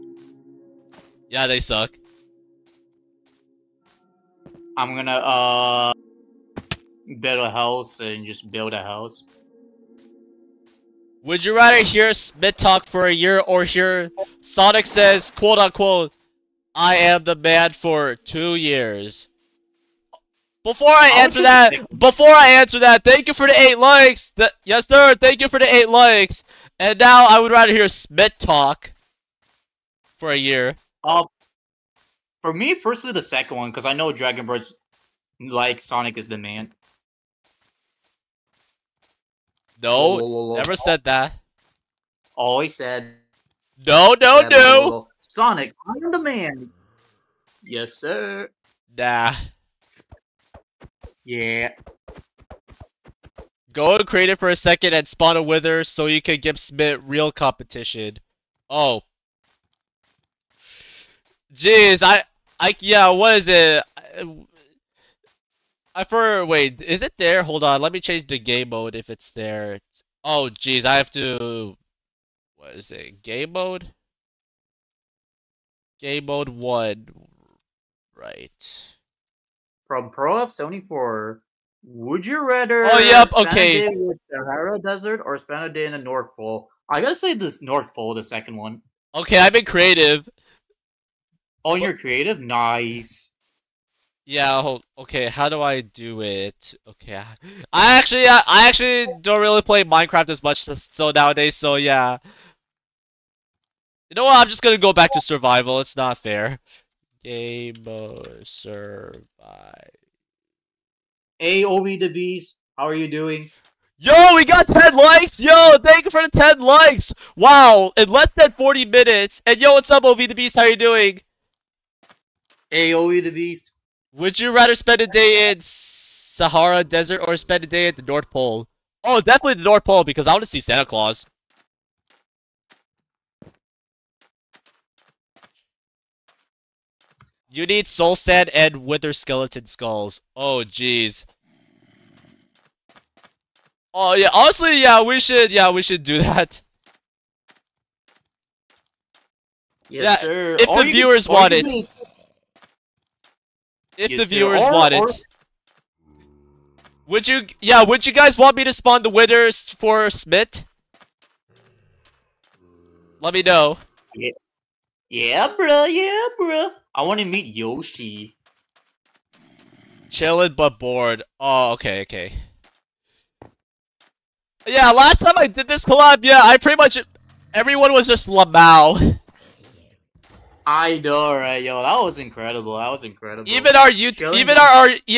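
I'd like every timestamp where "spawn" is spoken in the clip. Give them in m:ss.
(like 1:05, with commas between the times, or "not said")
0:55, 2:38.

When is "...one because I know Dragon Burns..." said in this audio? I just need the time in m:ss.
0:33.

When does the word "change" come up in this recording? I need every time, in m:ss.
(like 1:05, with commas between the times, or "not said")
1:07.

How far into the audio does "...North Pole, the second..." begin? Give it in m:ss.
1:27.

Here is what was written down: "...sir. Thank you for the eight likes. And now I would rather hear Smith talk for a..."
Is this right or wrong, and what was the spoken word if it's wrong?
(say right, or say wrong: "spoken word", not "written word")
right.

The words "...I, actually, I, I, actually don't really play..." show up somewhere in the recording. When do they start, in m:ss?
1:37.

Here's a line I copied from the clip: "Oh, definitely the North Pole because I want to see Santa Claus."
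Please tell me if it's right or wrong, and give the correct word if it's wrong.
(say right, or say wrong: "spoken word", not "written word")
right.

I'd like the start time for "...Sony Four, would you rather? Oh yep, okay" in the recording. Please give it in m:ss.
1:20.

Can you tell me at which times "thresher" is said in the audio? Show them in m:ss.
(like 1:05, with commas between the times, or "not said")
not said.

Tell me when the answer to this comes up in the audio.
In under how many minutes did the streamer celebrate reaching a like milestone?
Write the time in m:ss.
1:58.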